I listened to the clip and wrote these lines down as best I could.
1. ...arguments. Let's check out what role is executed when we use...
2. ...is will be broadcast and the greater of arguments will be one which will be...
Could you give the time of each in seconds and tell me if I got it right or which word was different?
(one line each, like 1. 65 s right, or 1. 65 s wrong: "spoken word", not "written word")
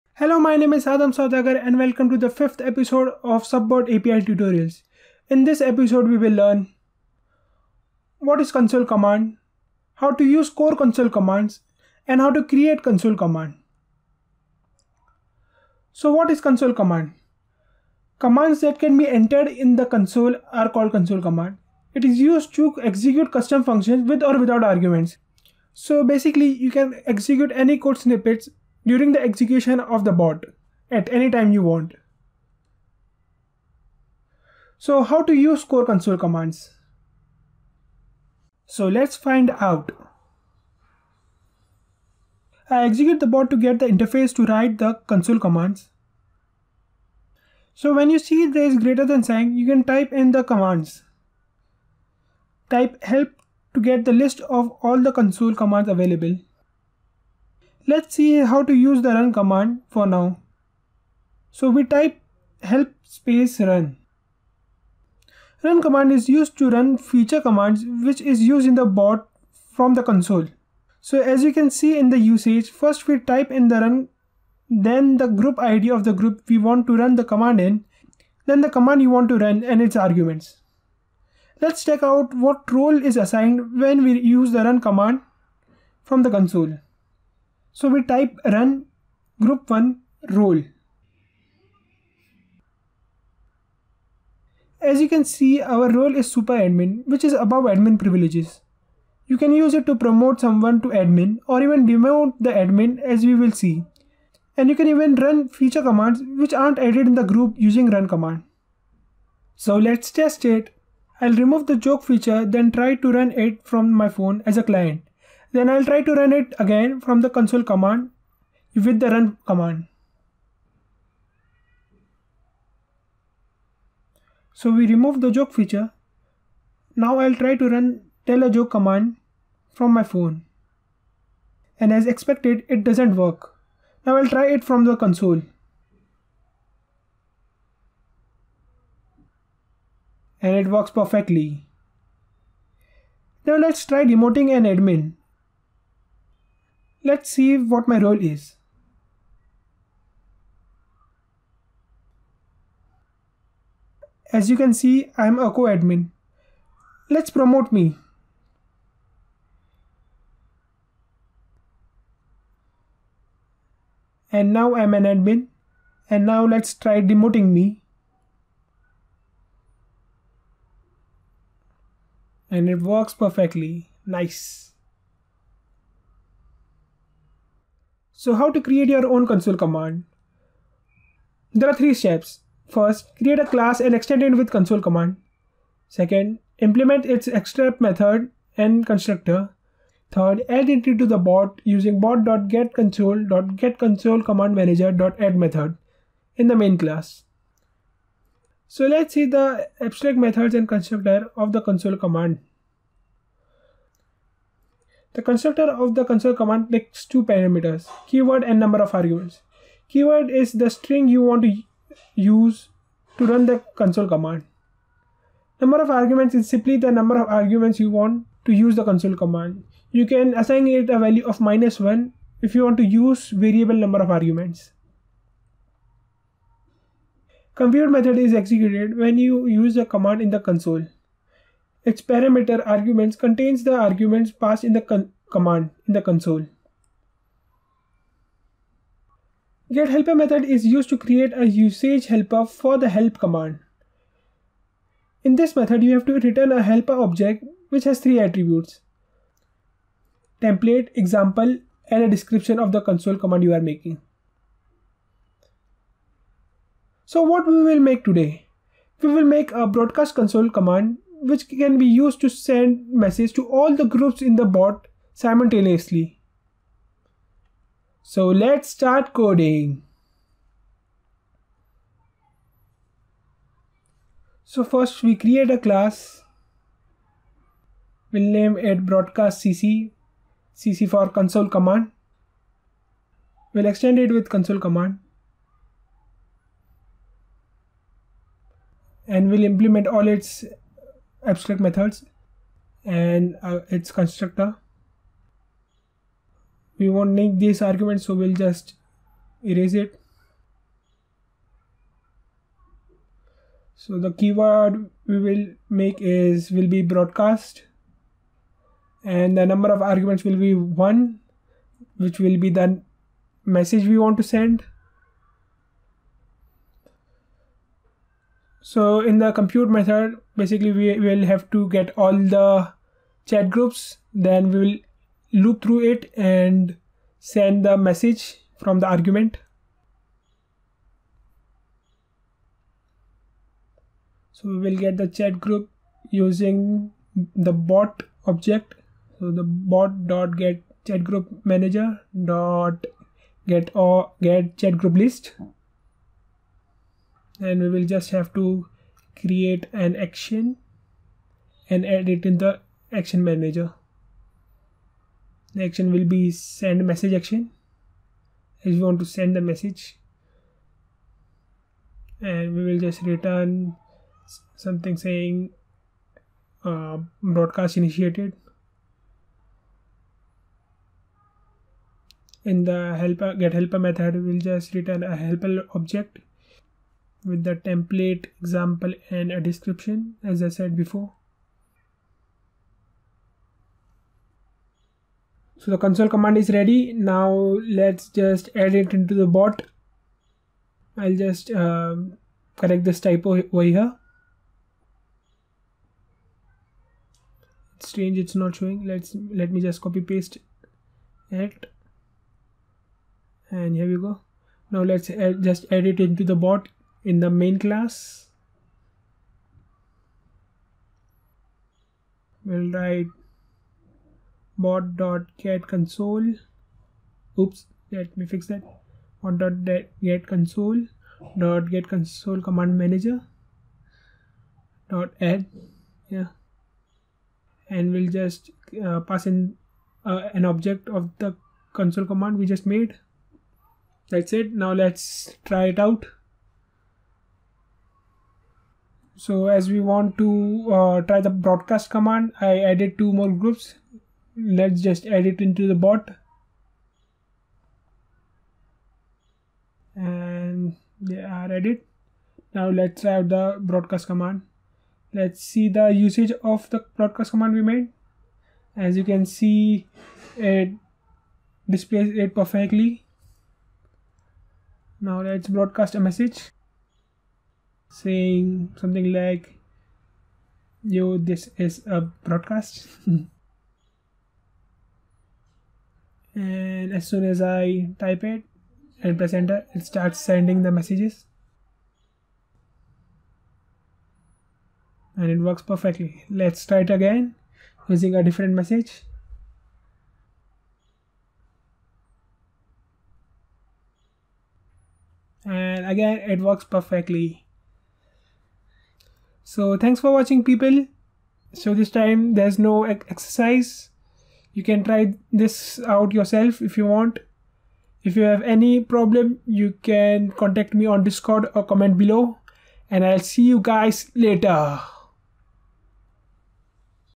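1. 79 s wrong: "assigned", not "executed"
2. 306 s wrong: "number", not "greater".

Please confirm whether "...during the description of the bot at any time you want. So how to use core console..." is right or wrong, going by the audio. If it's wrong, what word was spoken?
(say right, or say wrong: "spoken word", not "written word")
wrong: "execution", not "description".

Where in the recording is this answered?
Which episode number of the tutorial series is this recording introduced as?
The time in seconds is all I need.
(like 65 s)
2 s.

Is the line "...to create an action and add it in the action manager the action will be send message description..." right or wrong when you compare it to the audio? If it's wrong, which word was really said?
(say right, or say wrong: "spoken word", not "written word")
wrong: "action", not "description".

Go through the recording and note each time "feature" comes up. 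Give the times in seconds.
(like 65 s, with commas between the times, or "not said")
66 s, 105 s, 112 s, 125 s.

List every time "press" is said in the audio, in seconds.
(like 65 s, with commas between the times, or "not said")
479 s.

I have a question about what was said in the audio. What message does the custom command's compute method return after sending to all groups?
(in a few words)
Broadcast initiated.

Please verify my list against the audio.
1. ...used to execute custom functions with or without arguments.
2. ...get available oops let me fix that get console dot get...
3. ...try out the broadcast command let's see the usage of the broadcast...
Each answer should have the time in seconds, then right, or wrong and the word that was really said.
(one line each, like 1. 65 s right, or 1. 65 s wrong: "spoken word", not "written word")
1. 22 s right
2. 415 s wrong: "console", not "available"
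3. 453 s right.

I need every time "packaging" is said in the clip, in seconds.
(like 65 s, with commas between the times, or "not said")
not said.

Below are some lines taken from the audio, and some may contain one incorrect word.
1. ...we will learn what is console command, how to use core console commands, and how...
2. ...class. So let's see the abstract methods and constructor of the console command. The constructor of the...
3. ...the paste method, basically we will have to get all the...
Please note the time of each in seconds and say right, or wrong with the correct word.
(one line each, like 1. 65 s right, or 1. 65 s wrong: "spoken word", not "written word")
1. 6 s right
2. 196 s right
3. 319 s wrong: "compute", not "paste".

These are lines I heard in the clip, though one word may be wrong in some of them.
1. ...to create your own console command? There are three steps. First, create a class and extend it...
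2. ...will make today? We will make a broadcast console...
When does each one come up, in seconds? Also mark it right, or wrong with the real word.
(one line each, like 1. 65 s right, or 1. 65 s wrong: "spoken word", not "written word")
1. 178 s right
2. 257 s right.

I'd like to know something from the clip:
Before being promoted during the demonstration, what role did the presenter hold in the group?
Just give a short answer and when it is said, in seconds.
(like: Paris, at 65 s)
Co-admin, at 155 s.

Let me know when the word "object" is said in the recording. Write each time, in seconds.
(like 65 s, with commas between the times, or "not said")
246 s, 338 s, 375 s, 430 s.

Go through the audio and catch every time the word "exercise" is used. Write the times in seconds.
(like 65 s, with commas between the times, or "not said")
502 s.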